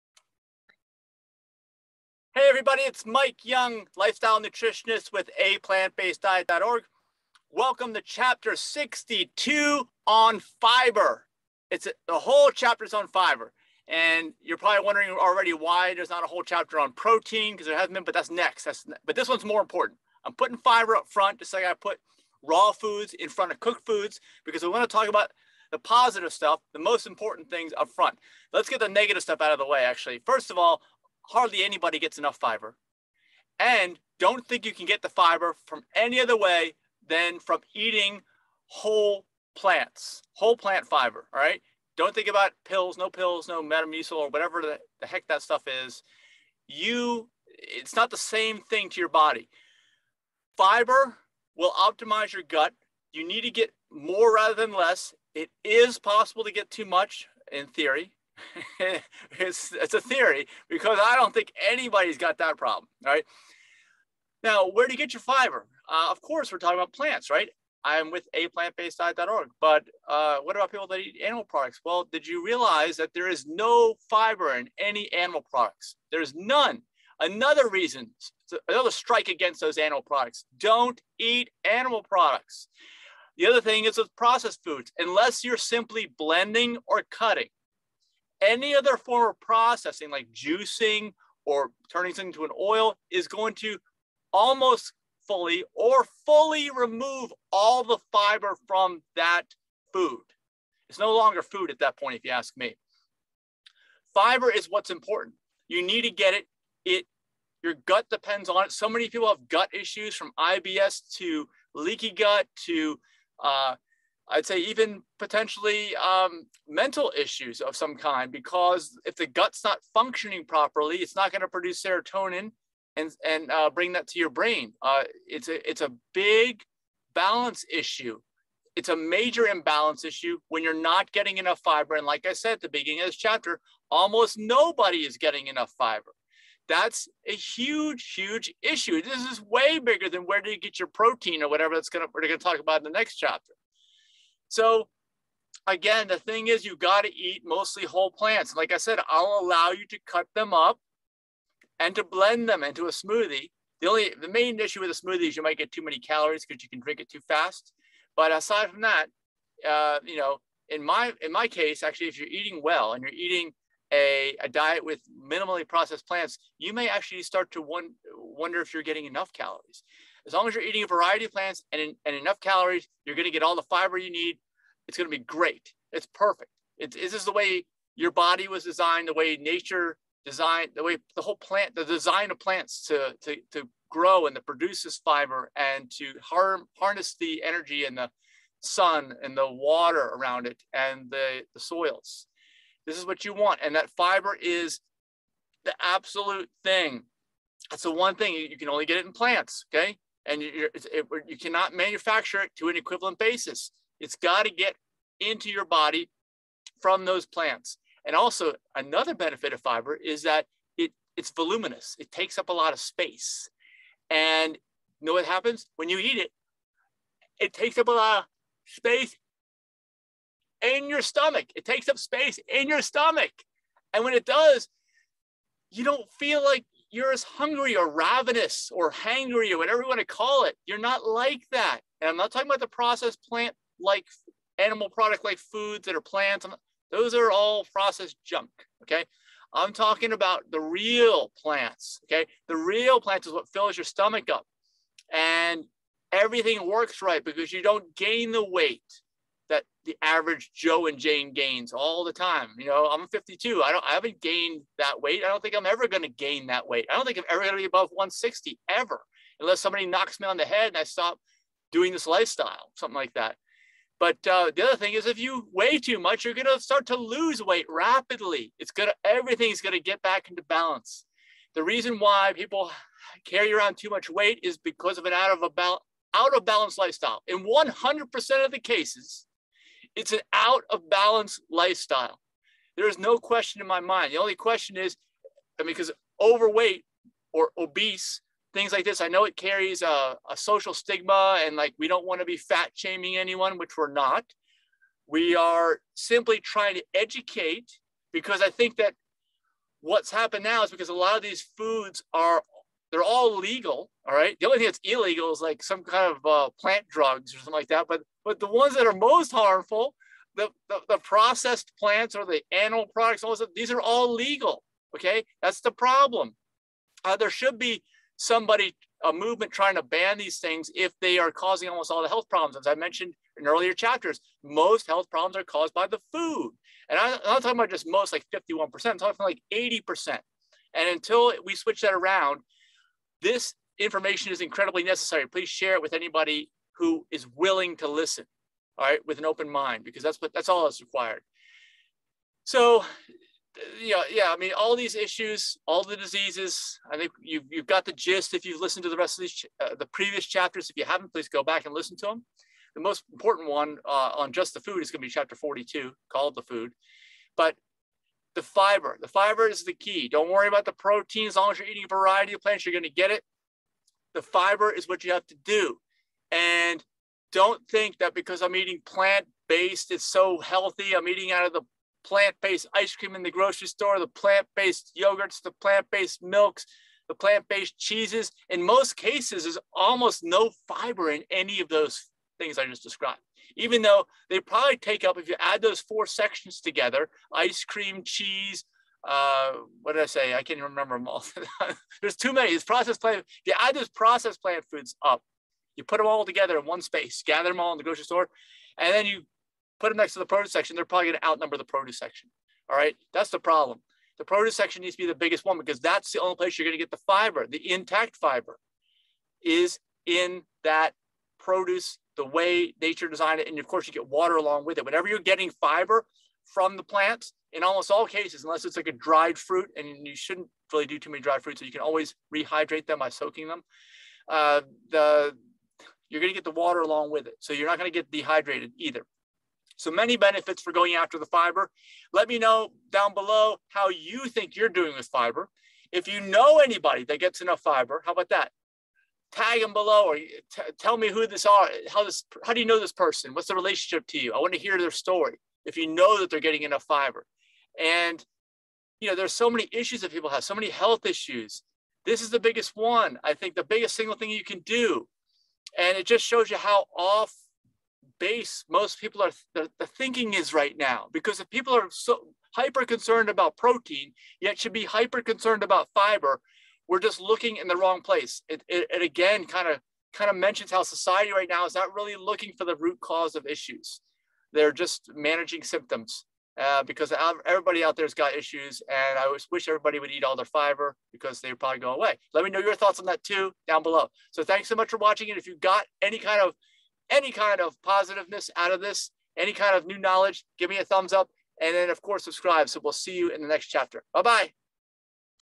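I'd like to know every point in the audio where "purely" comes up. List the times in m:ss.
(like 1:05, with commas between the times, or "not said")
not said.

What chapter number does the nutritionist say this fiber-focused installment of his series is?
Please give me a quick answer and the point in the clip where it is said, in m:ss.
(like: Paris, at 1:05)
62, at 0:08.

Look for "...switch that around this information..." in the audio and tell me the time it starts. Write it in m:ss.
5:31.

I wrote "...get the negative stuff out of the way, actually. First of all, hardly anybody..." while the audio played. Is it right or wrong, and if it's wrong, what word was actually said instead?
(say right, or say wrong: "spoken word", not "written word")
right.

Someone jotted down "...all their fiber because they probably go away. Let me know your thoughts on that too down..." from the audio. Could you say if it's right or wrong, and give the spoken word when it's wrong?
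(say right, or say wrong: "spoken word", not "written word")
right.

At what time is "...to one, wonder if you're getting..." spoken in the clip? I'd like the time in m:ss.
2:47.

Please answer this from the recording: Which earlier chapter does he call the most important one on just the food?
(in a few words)
Chapter 42.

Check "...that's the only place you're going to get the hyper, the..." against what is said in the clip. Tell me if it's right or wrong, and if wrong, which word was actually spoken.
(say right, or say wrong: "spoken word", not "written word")
wrong: "fiber", not "hyper".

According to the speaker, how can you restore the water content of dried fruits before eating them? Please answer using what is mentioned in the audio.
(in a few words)
Soaking them.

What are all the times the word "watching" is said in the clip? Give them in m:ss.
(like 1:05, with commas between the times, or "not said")
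8:04.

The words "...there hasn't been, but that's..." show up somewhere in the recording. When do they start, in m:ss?
0:17.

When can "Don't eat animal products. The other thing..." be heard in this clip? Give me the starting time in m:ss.
1:20.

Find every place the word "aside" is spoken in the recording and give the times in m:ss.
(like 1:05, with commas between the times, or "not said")
2:38.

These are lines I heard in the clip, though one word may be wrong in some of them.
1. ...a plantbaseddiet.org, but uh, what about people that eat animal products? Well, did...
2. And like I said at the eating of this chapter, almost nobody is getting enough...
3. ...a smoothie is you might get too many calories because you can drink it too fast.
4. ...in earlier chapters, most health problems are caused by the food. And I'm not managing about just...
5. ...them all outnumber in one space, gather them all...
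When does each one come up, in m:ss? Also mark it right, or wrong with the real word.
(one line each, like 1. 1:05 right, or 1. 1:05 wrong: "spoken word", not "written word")
1. 1:08 right
2. 2:11 wrong: "beginning", not "eating"
3. 2:34 right
4. 5:23 wrong: "talking", not "managing"
5. 6:35 wrong: "together", not "outnumber".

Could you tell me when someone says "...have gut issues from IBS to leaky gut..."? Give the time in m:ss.
1:49.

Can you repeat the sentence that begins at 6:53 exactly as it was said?
And of course, you get water along with it.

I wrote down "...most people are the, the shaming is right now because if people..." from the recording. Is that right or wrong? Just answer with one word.
wrong.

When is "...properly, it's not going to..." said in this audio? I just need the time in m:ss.
2:00.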